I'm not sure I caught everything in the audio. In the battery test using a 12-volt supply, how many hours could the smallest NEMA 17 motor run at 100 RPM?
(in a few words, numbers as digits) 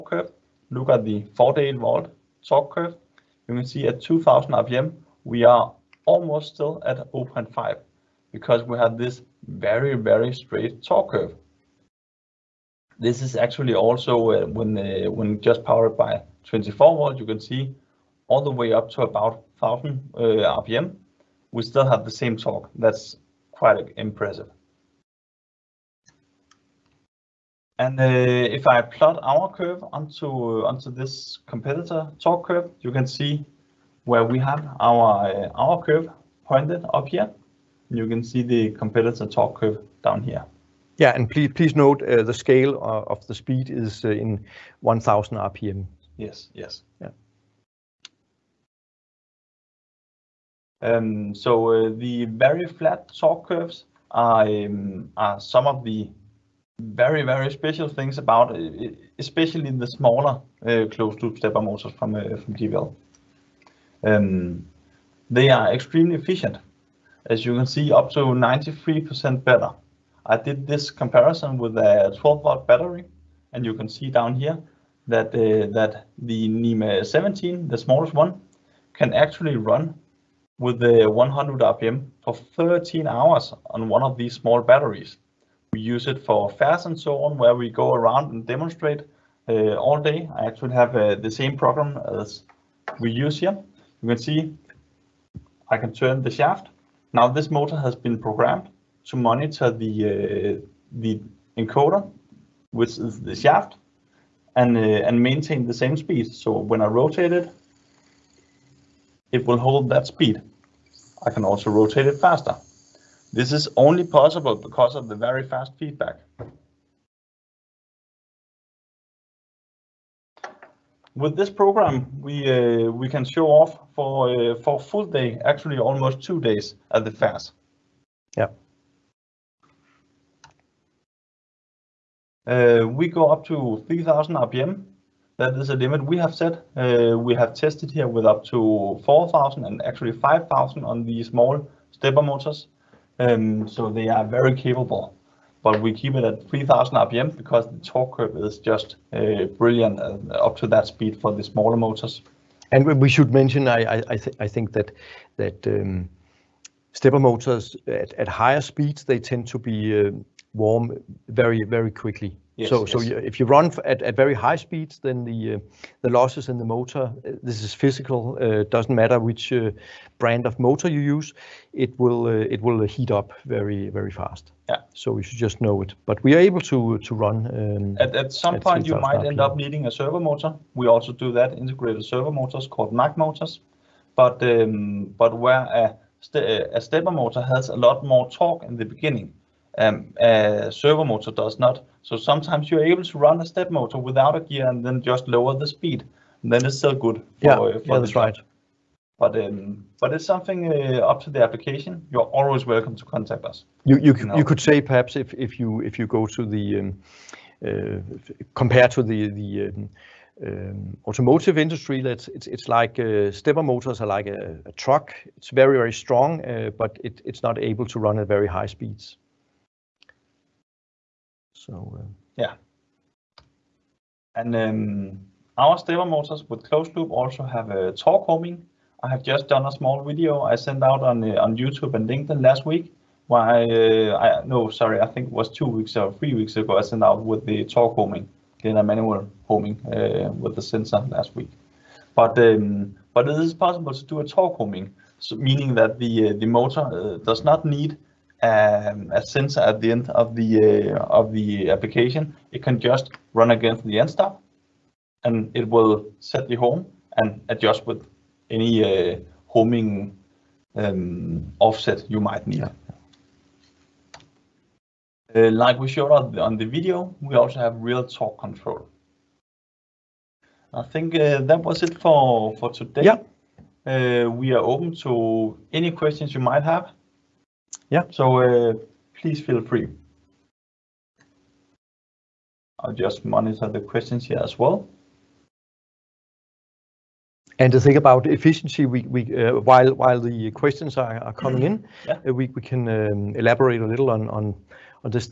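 13 hours.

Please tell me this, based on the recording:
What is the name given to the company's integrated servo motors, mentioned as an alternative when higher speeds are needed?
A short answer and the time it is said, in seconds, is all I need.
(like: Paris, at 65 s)
MAC motors, at 182 s.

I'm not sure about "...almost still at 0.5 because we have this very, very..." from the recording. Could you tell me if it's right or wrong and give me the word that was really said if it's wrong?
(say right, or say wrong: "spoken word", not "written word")
right.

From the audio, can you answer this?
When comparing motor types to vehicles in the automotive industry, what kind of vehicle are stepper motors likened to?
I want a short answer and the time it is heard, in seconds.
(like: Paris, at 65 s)
a truck, at 214 s.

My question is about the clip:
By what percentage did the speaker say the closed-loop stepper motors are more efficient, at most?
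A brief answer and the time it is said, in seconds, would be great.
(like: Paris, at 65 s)
93%, at 68 s.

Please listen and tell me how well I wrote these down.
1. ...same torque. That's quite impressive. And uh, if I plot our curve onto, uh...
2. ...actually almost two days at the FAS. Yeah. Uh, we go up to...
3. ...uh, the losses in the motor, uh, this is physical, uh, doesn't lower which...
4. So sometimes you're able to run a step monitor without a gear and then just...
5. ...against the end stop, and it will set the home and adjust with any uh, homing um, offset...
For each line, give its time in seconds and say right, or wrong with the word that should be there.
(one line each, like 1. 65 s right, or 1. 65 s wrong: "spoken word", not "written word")
1. 22 s right
2. 125 s right
3. 165 s wrong: "matter", not "lower"
4. 192 s wrong: "motor", not "monitor"
5. 253 s right.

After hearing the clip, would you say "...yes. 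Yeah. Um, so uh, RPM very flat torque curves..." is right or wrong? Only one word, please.
wrong.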